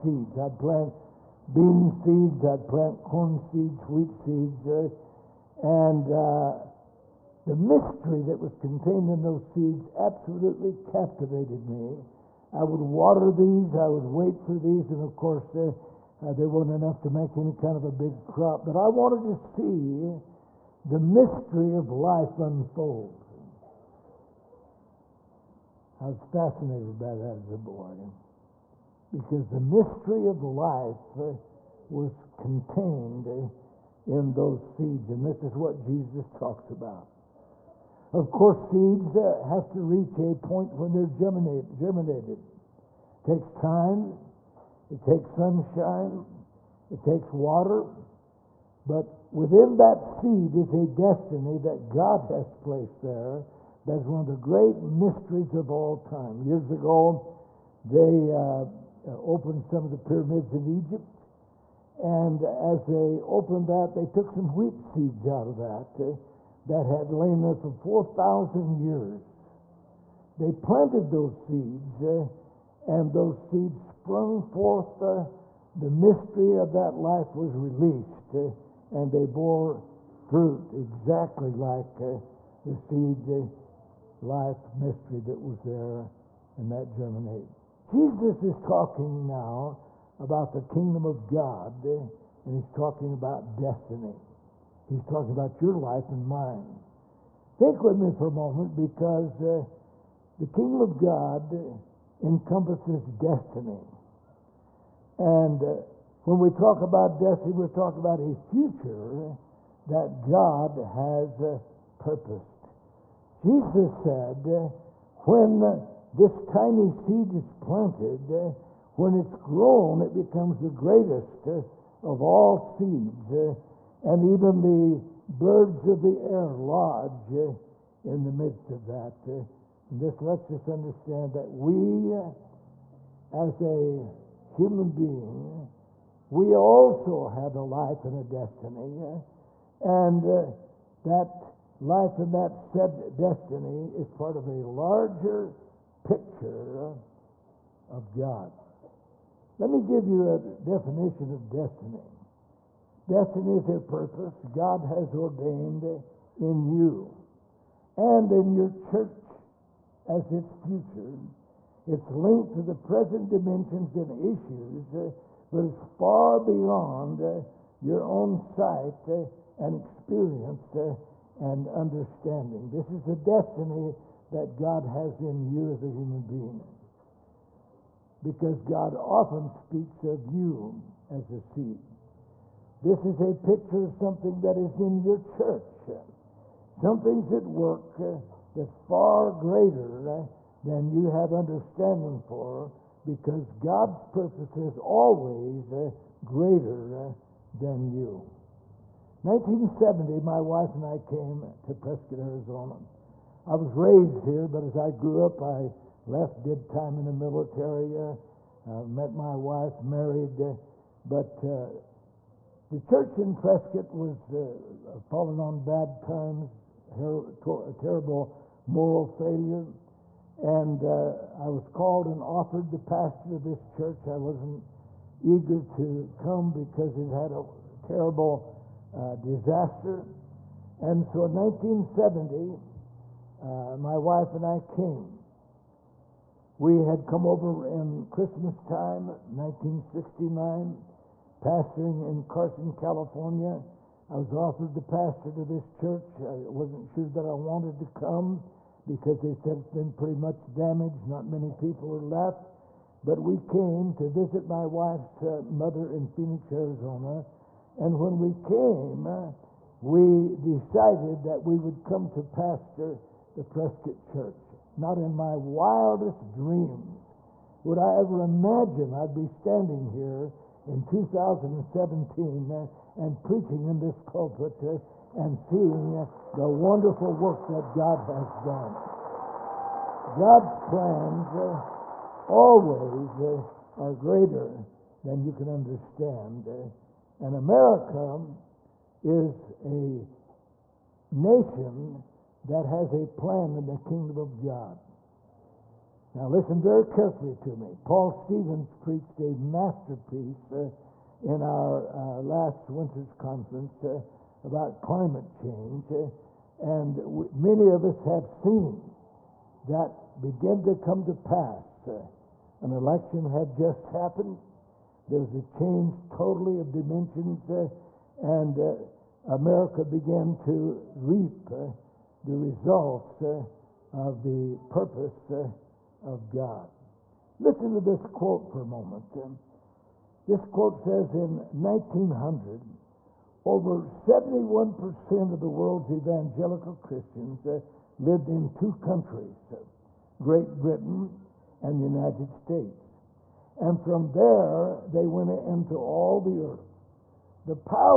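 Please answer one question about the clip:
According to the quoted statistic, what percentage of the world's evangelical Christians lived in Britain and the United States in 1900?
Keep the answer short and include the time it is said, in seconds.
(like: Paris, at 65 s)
71%, at 333 s.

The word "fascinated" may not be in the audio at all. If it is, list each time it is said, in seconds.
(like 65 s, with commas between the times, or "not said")
26 s.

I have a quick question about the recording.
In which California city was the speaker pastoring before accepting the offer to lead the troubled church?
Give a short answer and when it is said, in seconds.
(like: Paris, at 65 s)
Carson, at 242 s.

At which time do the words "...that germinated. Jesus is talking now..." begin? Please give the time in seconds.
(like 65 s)
86 s.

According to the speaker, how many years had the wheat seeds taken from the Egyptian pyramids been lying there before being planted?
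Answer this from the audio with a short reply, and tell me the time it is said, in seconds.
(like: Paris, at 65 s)
4,000, at 67 s.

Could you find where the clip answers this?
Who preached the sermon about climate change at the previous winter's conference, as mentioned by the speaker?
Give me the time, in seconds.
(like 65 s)
297 s.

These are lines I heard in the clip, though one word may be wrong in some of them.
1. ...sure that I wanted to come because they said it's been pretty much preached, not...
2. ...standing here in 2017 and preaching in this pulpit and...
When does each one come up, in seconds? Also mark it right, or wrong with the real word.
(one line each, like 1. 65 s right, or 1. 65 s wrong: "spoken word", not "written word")
1. 246 s wrong: "damaged", not "preached"
2. 269 s right.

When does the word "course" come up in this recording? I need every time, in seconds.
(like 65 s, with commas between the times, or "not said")
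15 s, 38 s.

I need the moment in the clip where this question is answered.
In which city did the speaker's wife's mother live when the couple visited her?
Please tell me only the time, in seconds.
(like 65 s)
256 s.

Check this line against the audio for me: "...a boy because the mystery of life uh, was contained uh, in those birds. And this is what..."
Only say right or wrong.
wrong.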